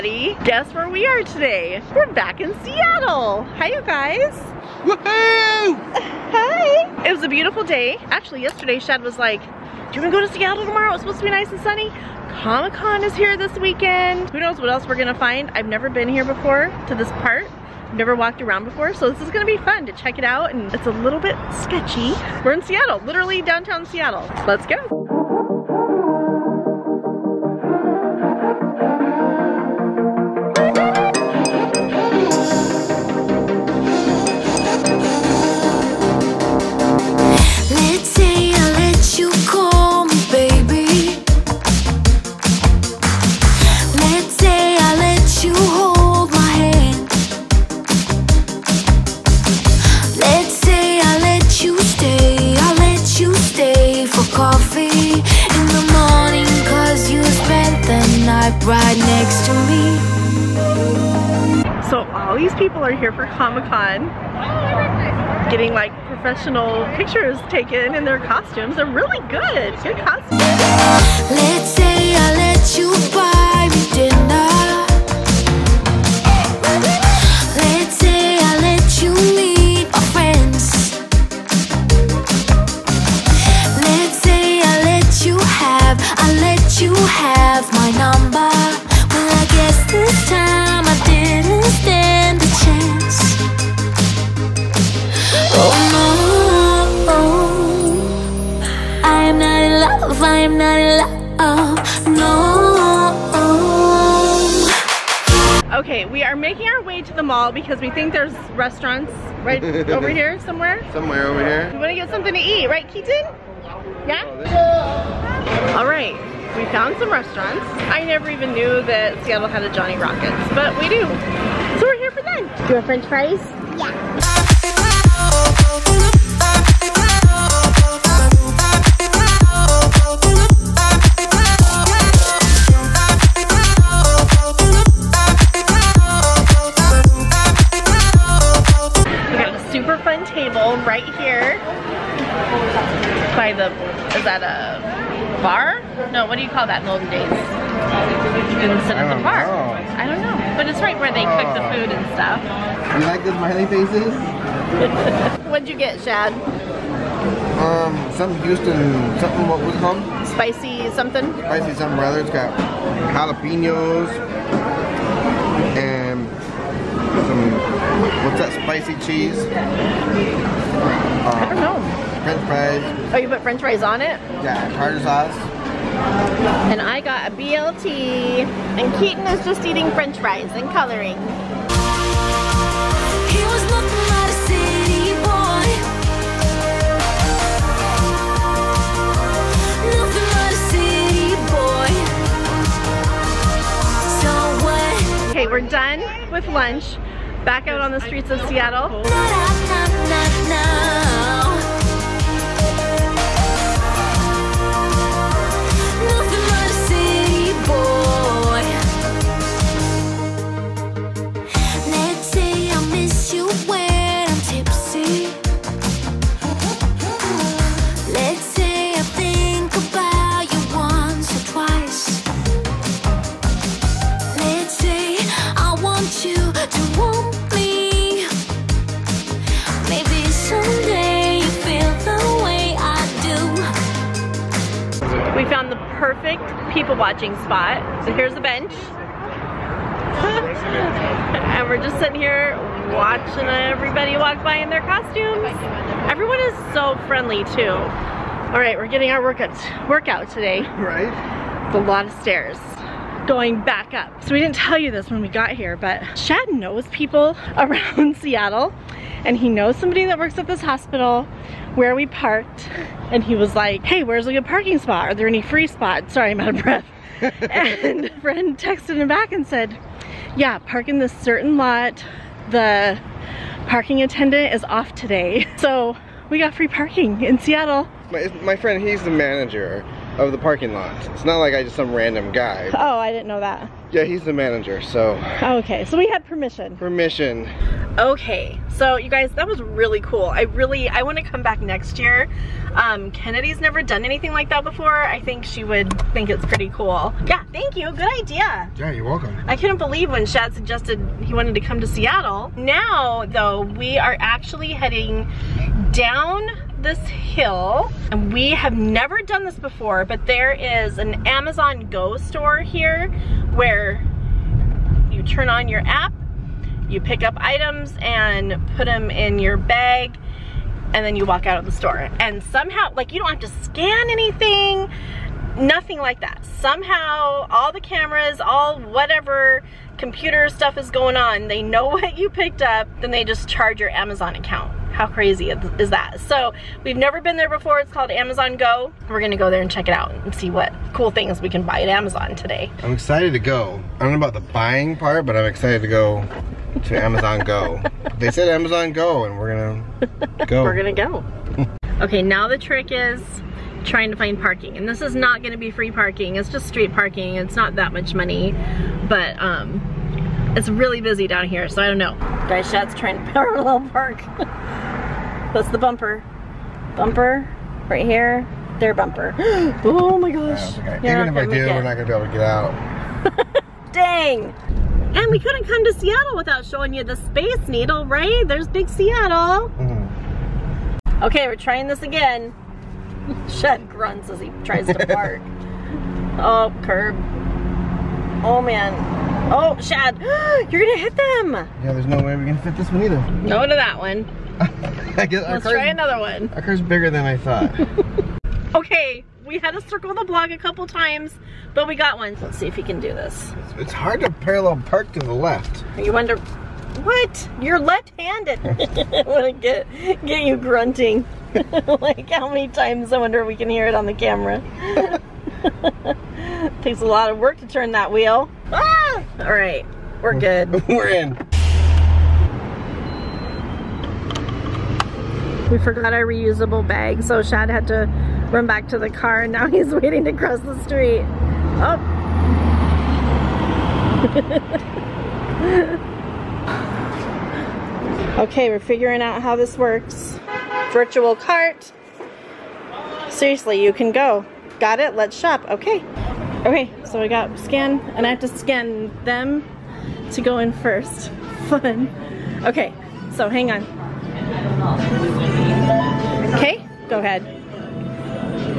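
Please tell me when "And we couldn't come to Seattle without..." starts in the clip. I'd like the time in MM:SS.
06:15.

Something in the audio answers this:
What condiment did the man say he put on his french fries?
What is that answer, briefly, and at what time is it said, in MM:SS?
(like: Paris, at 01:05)
Tartar sauce, at 02:54.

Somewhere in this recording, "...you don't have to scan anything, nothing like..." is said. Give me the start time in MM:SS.
05:23.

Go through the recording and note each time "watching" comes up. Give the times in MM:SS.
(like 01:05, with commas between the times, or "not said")
03:56, 04:02.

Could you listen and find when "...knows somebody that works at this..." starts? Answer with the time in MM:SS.
04:19.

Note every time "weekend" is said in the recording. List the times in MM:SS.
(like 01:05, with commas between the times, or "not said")
00:13.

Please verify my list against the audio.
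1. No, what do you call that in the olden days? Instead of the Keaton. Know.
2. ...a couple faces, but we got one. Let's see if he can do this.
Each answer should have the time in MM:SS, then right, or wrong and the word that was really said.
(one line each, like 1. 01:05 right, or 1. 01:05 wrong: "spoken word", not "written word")
1. 02:26 wrong: "Bar", not "Keaton"
2. 06:40 wrong: "times", not "faces".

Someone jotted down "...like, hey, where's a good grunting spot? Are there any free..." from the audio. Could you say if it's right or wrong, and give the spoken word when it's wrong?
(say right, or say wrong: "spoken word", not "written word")
wrong: "parking", not "grunting".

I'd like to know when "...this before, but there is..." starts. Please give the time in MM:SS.
05:09.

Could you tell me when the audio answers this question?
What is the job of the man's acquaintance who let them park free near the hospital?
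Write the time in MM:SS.
04:39.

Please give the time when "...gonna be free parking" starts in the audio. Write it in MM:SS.
05:55.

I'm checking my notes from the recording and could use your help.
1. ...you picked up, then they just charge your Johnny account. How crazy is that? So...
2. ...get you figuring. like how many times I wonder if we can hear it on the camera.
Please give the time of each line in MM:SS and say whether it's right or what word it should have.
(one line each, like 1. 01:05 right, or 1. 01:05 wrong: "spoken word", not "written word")
1. 05:32 wrong: "Amazon", not "Johnny"
2. 06:50 wrong: "grunting", not "figuring".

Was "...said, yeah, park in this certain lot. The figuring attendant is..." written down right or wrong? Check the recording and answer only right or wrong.
wrong.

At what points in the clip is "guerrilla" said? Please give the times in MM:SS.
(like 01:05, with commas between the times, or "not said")
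not said.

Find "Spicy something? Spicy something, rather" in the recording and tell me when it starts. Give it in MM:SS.
02:40.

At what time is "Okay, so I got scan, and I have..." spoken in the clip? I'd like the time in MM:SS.
07:26.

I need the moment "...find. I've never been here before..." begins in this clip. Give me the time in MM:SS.
00:15.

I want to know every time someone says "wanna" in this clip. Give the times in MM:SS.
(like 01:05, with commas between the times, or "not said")
00:10, 04:51.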